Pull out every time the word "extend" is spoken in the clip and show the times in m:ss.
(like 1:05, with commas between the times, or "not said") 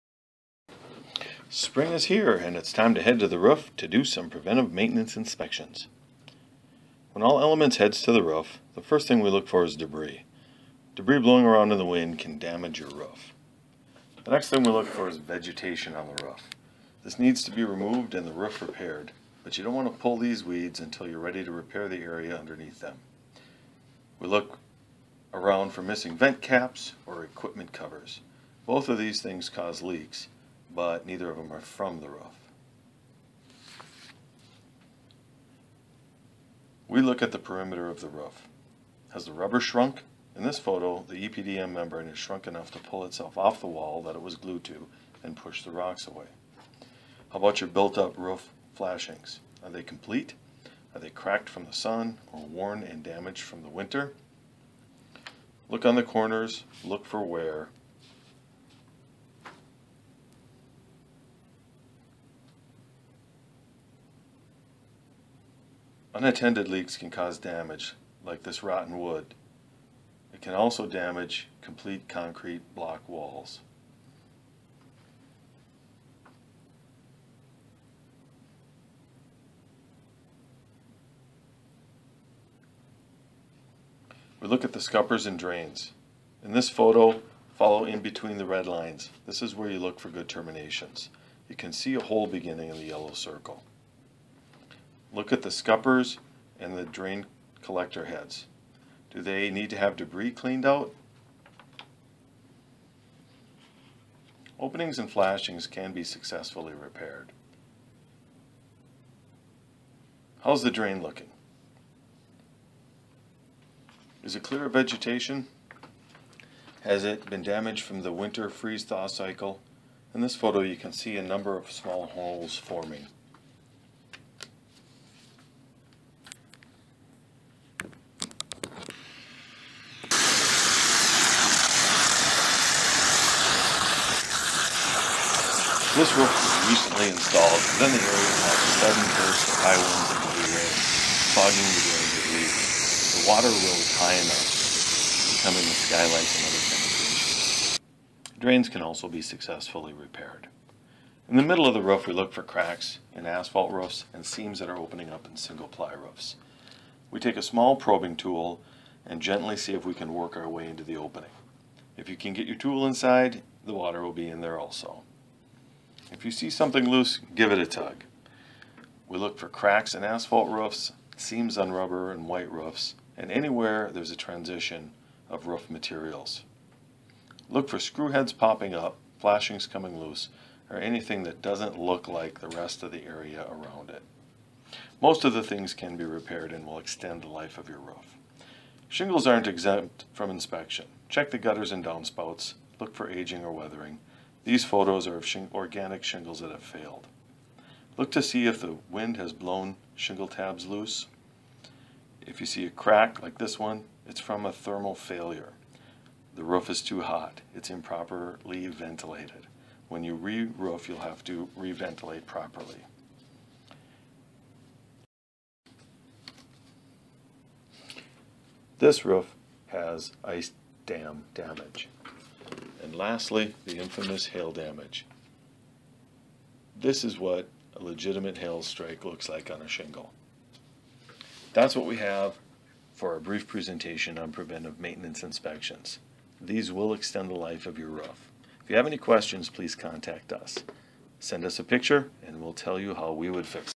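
3:06, 3:56.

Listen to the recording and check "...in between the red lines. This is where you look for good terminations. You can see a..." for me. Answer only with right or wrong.
right.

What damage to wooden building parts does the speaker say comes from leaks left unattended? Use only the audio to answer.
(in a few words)
Rotten wood.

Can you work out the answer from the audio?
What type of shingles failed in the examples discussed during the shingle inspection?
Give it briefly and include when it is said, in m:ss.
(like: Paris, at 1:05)
Organic shingles, at 3:15.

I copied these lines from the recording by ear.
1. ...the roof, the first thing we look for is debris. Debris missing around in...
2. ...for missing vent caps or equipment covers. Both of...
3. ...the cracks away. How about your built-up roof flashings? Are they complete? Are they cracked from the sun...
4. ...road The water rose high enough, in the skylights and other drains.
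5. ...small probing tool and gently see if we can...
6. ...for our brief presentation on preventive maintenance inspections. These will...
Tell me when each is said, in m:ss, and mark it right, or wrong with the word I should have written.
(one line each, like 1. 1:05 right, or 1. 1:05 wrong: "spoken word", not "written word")
1. 0:08 wrong: "blowing", not "missing"
2. 0:25 right
3. 0:45 wrong: "rocks", not "cracks"
4. 2:22 wrong: "penetrations", not "drains"
5. 2:37 right
6. 3:52 right.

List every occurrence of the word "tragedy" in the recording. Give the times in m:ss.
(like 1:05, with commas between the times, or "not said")
not said.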